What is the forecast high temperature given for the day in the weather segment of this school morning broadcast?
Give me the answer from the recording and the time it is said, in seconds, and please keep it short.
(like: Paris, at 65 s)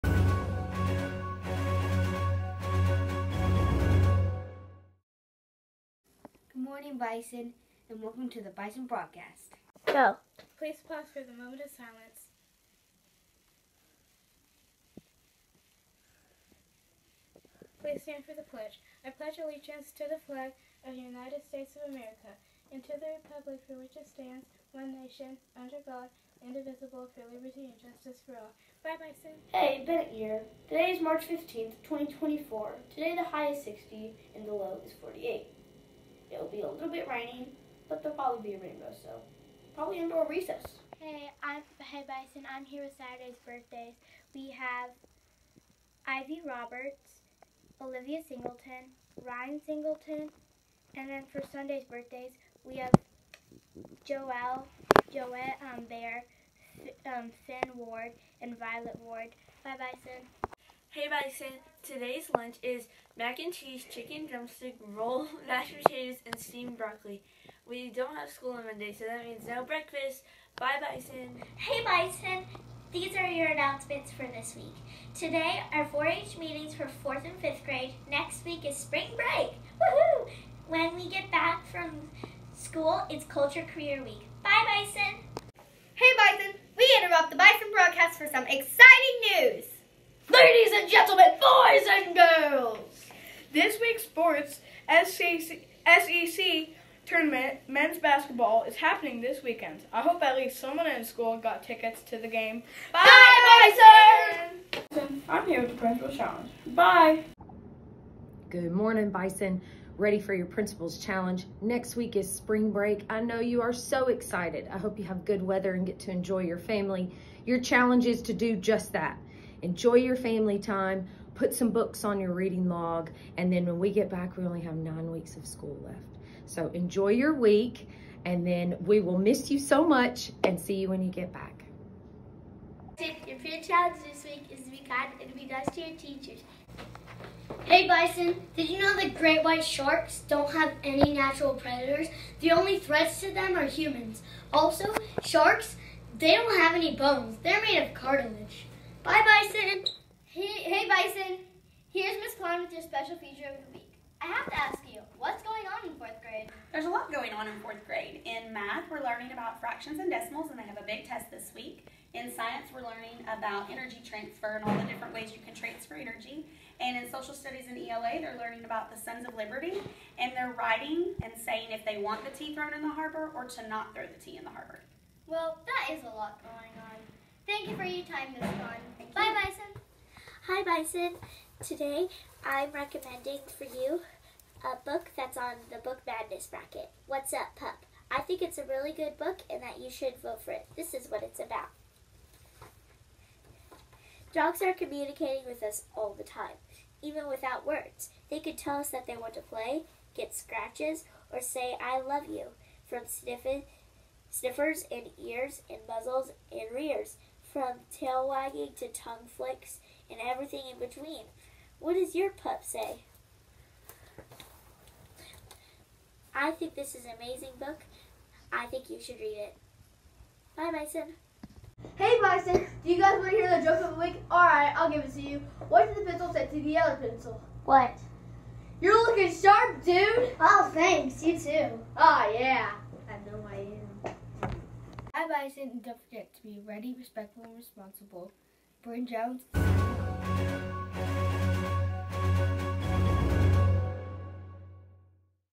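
60, at 33 s.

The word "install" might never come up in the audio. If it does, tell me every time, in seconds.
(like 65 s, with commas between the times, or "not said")
not said.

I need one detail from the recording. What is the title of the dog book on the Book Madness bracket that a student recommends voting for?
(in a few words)
What's Up, Pup.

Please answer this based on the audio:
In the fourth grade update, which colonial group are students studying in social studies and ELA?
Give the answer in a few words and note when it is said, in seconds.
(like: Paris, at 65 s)
Sons of Liberty, at 169 s.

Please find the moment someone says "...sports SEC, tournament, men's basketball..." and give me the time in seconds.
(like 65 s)
94 s.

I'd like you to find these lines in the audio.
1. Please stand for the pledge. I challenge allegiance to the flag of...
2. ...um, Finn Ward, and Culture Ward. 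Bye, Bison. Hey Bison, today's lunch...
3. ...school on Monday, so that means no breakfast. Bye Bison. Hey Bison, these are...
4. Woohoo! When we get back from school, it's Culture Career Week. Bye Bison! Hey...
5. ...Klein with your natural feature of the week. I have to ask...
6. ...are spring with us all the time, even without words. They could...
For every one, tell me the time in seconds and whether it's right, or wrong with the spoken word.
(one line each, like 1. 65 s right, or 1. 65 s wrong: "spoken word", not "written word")
1. 17 s wrong: "pledge", not "challenge"
2. 57 s wrong: "Violet", not "Culture"
3. 68 s right
4. 79 s right
5. 152 s wrong: "special", not "natural"
6. 194 s wrong: "communicating", not "spring".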